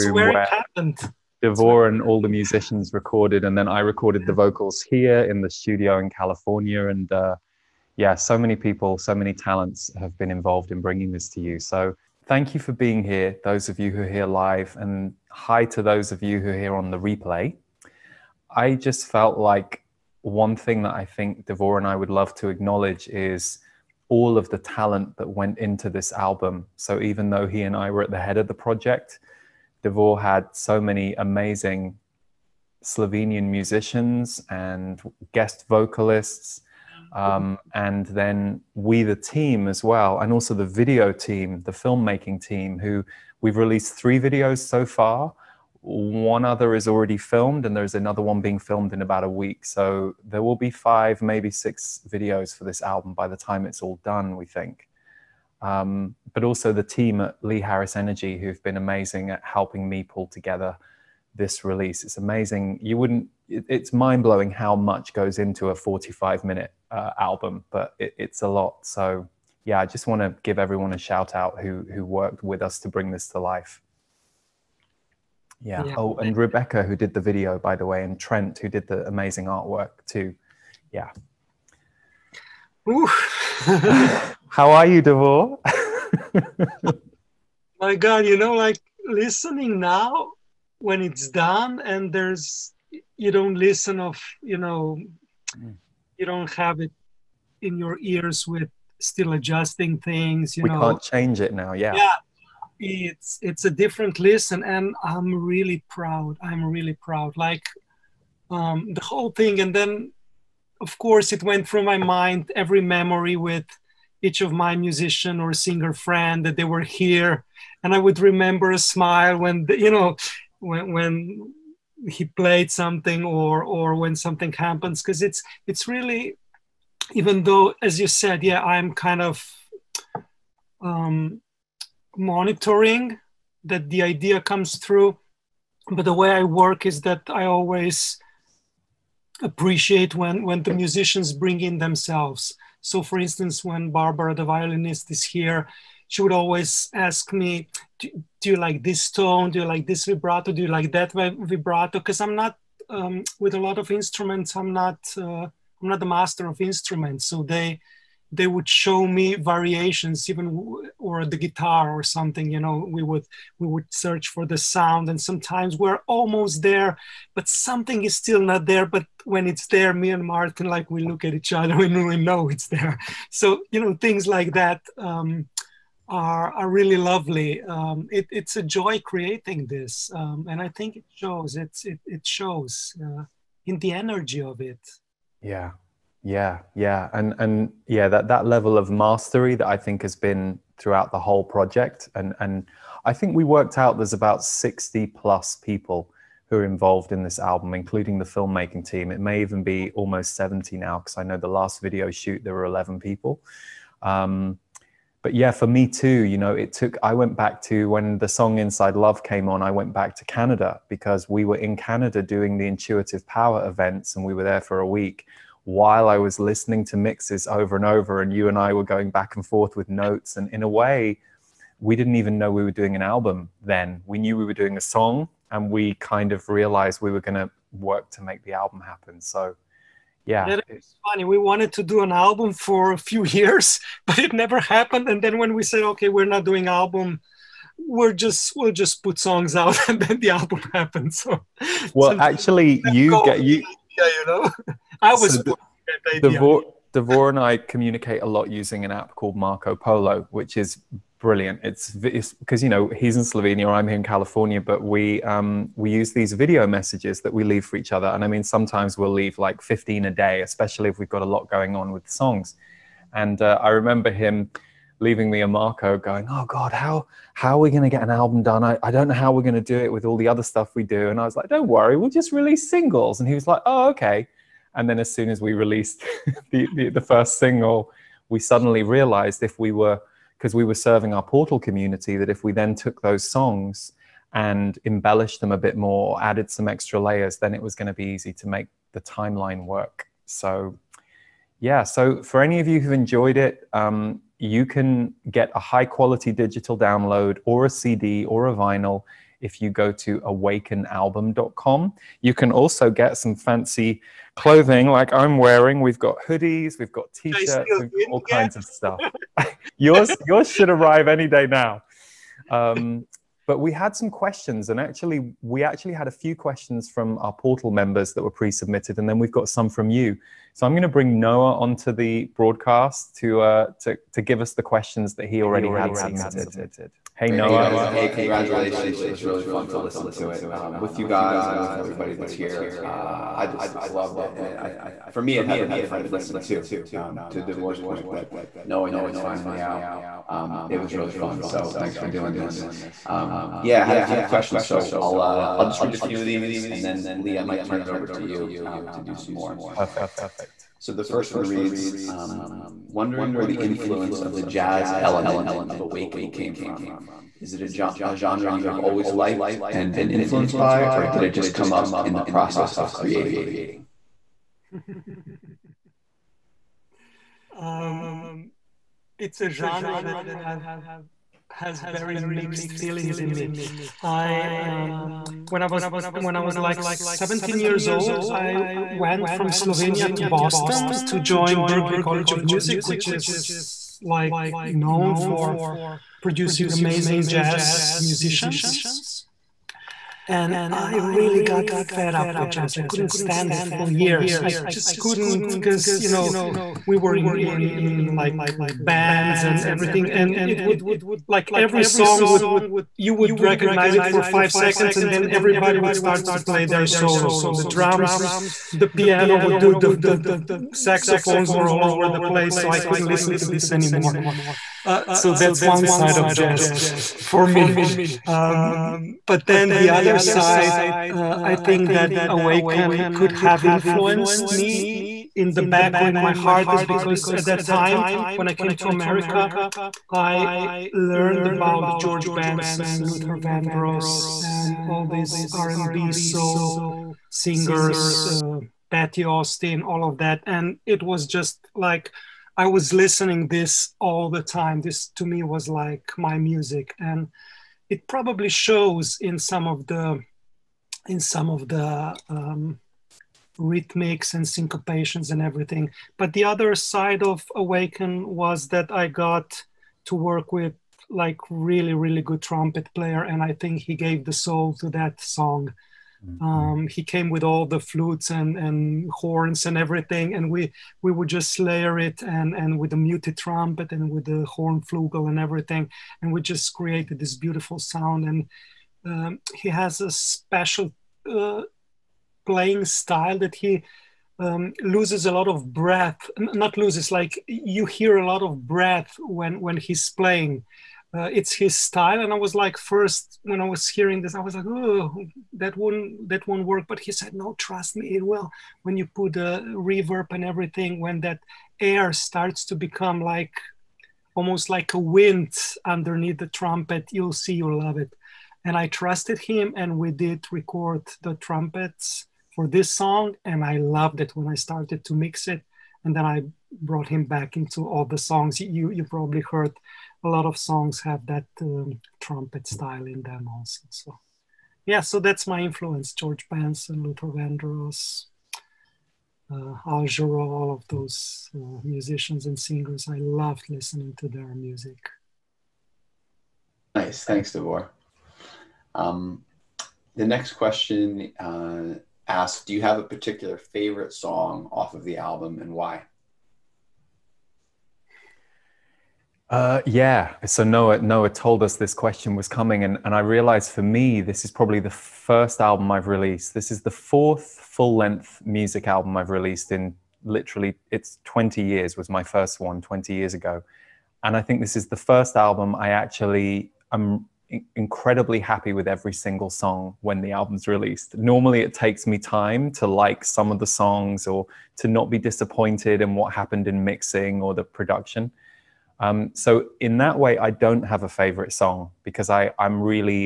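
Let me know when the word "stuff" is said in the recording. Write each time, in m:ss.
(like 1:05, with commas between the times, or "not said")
4:30, 5:08.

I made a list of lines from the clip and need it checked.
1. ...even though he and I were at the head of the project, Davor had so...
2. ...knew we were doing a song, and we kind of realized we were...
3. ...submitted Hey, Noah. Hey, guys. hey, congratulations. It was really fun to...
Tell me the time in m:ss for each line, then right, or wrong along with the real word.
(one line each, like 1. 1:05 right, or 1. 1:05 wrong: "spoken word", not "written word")
1. 0:27 right
2. 3:44 right
3. 5:25 right.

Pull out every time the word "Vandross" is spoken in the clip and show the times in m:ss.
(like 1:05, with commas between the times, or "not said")
7:13, 8:47.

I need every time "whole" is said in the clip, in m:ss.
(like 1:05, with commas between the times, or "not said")
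1:49, 3:11.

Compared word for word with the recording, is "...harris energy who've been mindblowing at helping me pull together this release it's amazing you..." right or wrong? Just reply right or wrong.
wrong.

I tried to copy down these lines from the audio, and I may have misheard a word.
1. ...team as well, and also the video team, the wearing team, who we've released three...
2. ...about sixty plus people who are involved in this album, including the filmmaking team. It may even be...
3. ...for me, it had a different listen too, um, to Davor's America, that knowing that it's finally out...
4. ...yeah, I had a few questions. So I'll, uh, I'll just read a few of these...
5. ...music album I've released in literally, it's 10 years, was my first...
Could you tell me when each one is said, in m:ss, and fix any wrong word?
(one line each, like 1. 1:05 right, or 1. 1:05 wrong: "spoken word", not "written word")
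1. 0:39 wrong: "filmmaking", not "wearing"
2. 3:14 right
3. 5:35 wrong: "Point", not "America"
4. 5:43 right
5. 9:18 wrong: "20", not "10".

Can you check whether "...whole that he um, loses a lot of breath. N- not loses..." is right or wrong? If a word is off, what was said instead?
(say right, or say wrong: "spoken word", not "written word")
wrong: "style", not "whole".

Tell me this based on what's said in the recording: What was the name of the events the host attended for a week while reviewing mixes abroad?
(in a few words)
Intuitive Power.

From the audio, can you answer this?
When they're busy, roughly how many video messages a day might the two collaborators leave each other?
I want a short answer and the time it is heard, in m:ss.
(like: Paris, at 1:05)
15, at 4:19.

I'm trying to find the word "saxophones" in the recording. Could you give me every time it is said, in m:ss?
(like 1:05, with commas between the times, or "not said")
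6:50.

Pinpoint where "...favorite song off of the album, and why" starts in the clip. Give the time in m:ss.
9:03.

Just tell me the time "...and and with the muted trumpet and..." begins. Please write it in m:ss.
7:52.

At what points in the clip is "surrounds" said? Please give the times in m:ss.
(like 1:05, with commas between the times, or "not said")
not said.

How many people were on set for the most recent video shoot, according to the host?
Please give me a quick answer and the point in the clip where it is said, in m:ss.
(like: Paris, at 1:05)
11, at 3:22.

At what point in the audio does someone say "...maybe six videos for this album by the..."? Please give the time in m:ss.
0:51.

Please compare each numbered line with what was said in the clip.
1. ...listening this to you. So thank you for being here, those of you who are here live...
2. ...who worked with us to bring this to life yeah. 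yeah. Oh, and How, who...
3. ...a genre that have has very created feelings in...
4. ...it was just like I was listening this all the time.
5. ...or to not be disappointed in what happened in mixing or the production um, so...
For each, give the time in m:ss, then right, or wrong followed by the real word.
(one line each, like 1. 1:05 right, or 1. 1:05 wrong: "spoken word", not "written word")
1. 0:10 wrong: "bringing", not "listening"
2. 1:11 wrong: "Rebecca", not "How"
3. 6:09 wrong: "mixed", not "created"
4. 7:20 right
5. 9:34 right.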